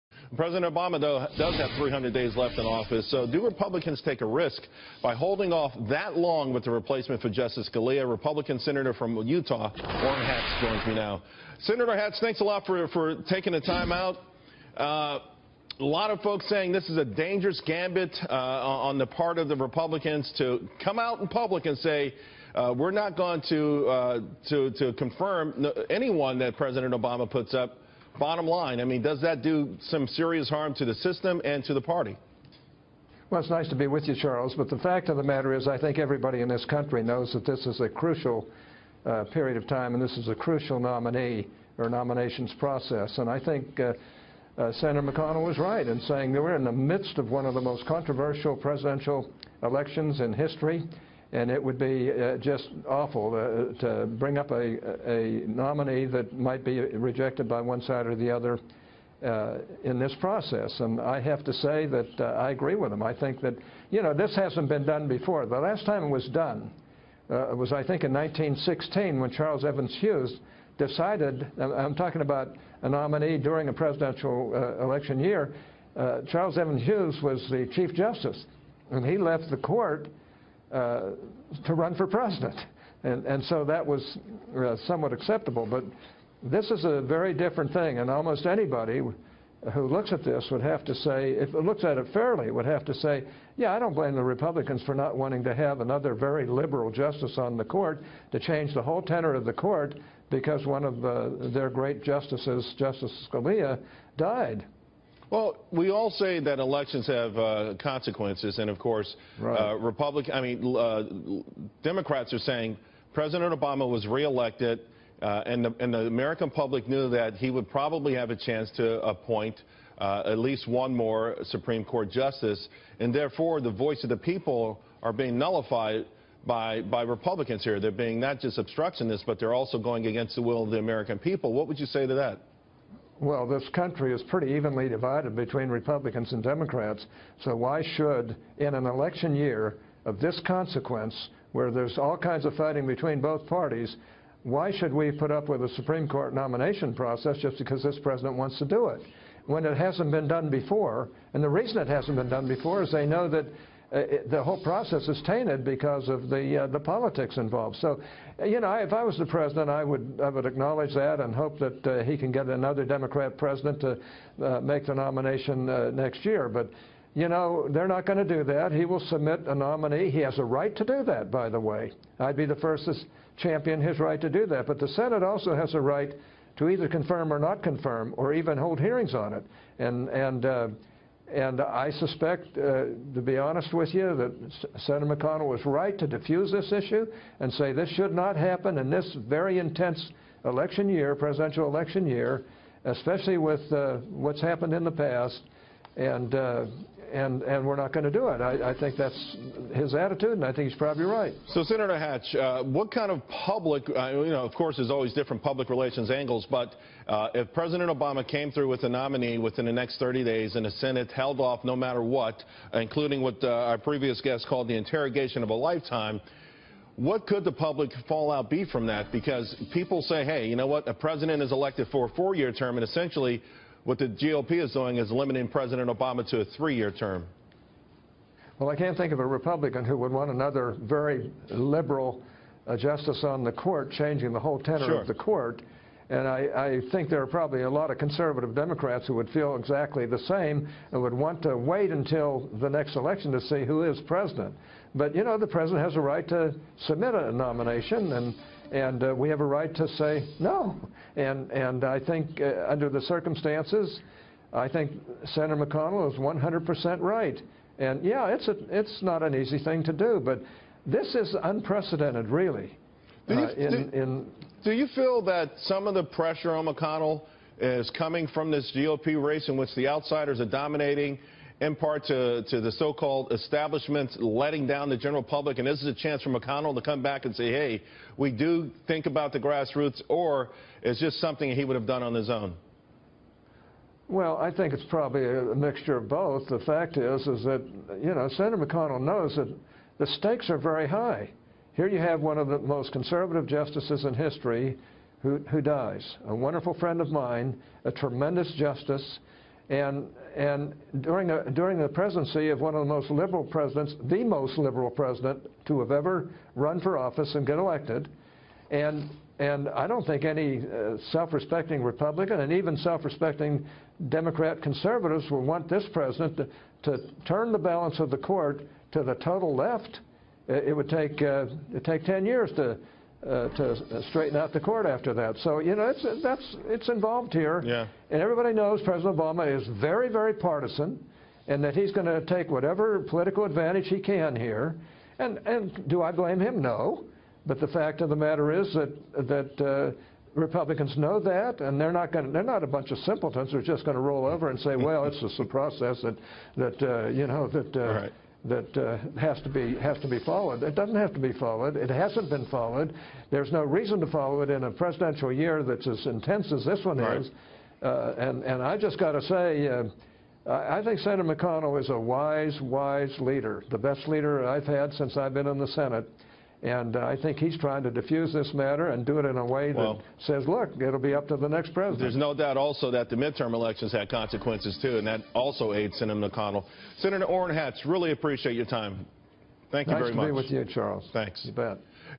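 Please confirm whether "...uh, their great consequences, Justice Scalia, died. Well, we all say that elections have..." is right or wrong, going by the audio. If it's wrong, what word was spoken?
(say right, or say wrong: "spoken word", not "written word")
wrong: "justices", not "consequences".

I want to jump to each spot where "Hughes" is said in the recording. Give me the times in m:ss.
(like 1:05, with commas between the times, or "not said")
1:10, 1:16.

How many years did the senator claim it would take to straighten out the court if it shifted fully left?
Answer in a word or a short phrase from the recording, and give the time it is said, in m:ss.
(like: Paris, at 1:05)
10, at 5:22.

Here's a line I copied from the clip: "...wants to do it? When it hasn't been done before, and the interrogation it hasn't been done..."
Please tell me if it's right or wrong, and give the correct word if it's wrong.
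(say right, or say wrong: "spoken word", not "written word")
wrong: "reason", not "interrogation".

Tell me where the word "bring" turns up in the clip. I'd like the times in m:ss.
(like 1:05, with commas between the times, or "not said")
0:54.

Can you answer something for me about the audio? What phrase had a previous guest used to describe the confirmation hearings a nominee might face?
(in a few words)
interrogation of a lifetime.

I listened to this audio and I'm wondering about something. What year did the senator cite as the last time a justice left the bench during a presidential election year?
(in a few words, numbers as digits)
1916.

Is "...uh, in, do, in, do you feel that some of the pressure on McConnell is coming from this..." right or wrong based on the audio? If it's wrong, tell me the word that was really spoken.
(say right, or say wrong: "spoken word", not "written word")
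right.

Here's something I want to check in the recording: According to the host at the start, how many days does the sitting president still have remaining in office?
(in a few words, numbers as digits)
300.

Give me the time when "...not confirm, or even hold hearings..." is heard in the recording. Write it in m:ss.
2:57.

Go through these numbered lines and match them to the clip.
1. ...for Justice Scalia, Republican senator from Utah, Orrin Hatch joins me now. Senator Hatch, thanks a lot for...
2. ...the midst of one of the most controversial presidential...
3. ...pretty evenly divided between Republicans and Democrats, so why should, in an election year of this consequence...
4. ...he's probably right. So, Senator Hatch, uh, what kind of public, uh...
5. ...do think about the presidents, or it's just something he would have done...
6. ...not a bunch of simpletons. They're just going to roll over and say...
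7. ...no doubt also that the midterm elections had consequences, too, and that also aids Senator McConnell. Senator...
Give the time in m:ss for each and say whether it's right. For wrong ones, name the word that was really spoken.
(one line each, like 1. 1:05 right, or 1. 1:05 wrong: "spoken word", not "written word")
1. 0:07 right
2. 0:46 right
3. 2:14 right
4. 3:20 right
5. 4:38 wrong: "grassroots", not "presidents"
6. 5:42 right
7. 6:12 right.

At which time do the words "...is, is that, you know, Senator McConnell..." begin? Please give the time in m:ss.
4:46.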